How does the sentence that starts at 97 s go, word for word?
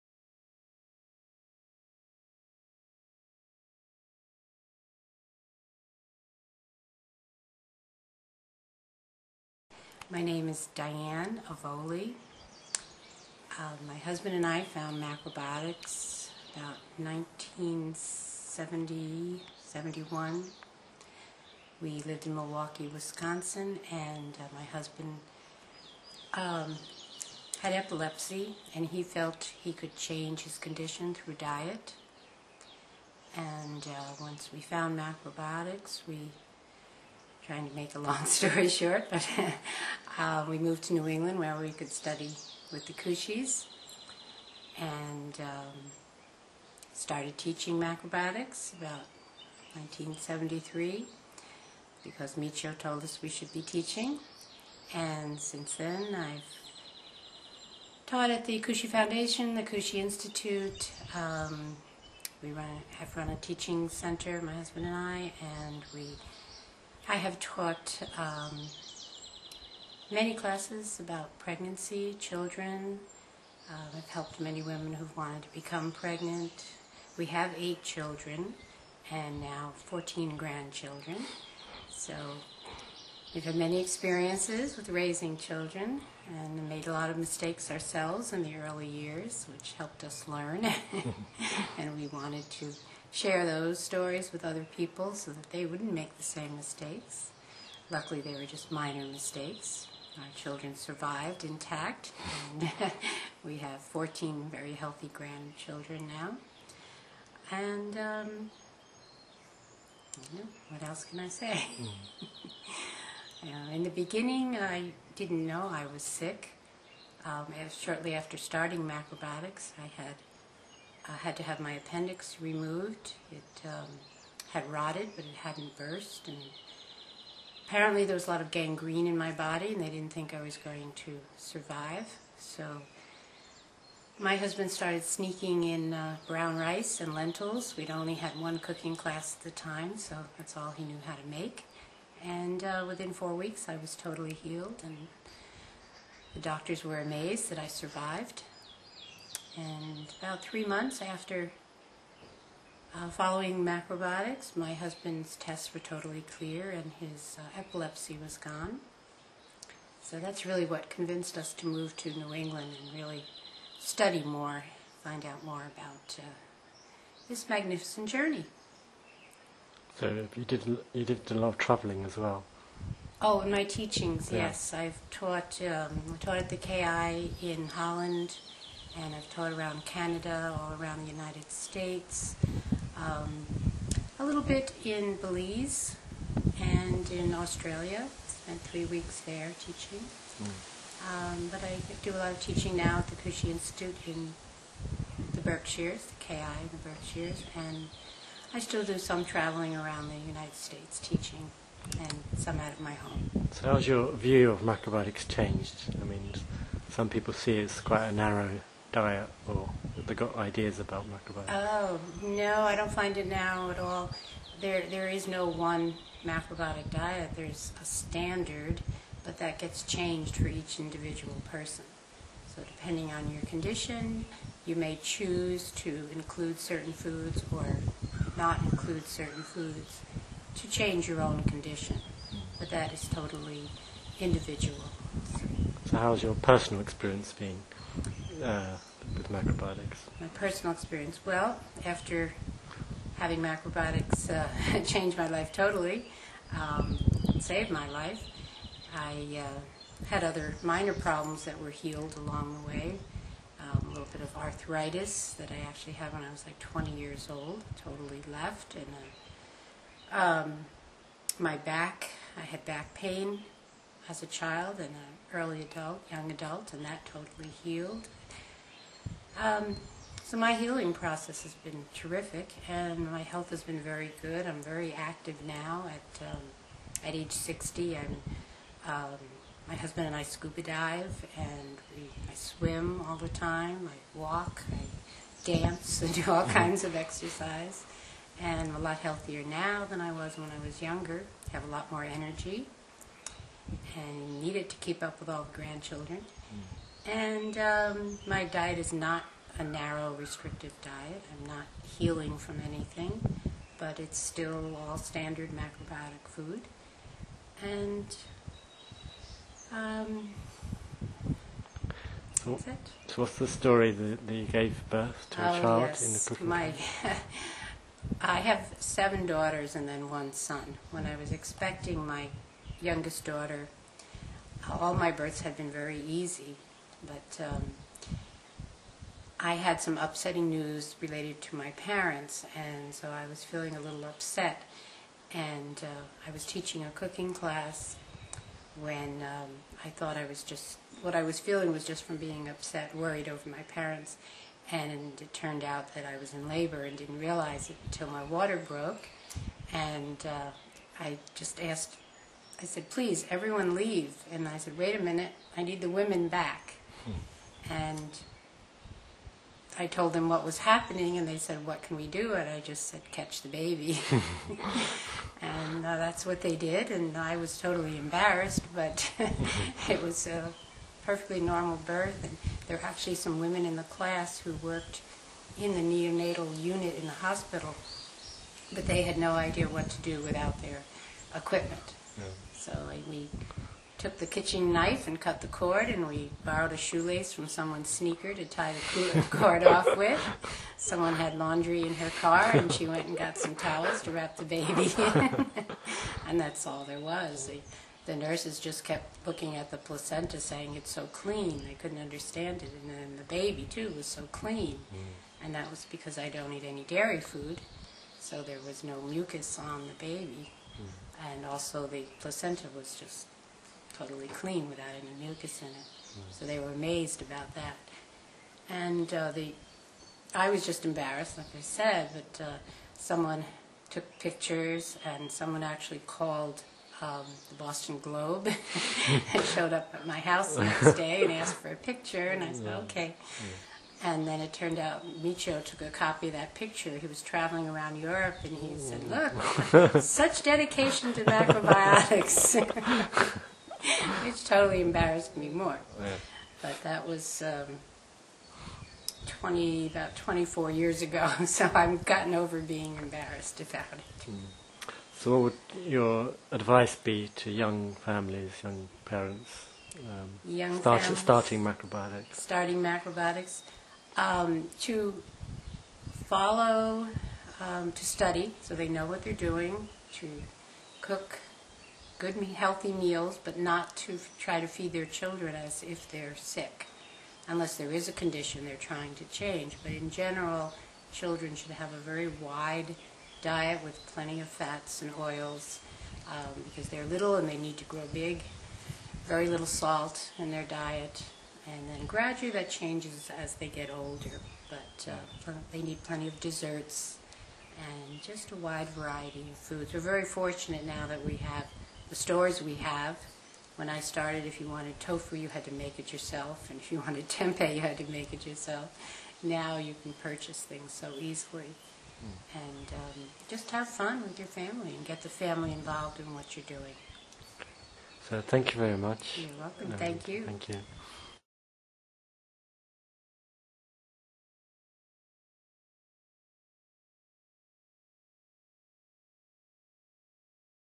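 Luckily, they were just minor mistakes.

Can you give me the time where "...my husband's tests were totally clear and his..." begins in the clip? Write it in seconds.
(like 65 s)
154 s.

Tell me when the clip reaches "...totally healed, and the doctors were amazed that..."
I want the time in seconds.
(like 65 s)
143 s.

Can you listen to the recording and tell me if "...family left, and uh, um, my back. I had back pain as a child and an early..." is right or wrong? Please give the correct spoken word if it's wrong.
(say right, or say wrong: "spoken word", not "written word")
wrong: "totally", not "family".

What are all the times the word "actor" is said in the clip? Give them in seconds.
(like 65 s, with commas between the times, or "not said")
not said.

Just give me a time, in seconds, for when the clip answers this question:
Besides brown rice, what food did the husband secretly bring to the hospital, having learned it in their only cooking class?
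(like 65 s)
137 s.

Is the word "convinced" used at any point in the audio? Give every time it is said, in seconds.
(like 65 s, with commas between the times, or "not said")
160 s.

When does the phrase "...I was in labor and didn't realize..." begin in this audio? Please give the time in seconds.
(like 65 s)
346 s.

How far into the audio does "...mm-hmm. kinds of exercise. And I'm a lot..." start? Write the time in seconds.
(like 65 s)
286 s.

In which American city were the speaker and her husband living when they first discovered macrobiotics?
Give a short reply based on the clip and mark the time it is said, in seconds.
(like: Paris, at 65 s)
Milwaukee, at 22 s.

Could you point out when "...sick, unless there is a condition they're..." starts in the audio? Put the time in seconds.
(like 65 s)
476 s.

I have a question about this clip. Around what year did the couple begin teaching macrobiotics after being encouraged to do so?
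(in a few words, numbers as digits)
1973.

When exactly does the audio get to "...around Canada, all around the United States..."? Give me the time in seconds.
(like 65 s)
179 s.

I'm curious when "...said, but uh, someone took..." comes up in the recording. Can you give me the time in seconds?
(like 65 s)
421 s.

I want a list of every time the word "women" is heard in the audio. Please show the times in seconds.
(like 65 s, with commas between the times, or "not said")
74 s, 355 s, 373 s.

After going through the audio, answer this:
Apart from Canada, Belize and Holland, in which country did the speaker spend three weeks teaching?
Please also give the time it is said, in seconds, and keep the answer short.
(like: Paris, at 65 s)
Australia, at 187 s.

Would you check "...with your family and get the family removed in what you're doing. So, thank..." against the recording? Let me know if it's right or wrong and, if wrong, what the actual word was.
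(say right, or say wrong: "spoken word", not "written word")
wrong: "involved", not "removed".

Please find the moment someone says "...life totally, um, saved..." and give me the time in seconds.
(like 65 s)
245 s.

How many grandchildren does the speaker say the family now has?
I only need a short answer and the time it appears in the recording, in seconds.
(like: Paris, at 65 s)
14, at 79 s.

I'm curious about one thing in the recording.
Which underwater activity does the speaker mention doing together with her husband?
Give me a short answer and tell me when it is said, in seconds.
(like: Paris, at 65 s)
scuba dive, at 280 s.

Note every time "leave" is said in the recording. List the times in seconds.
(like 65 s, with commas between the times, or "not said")
353 s.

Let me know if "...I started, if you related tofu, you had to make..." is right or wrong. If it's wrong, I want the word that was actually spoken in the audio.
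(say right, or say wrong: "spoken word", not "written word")
wrong: "wanted", not "related".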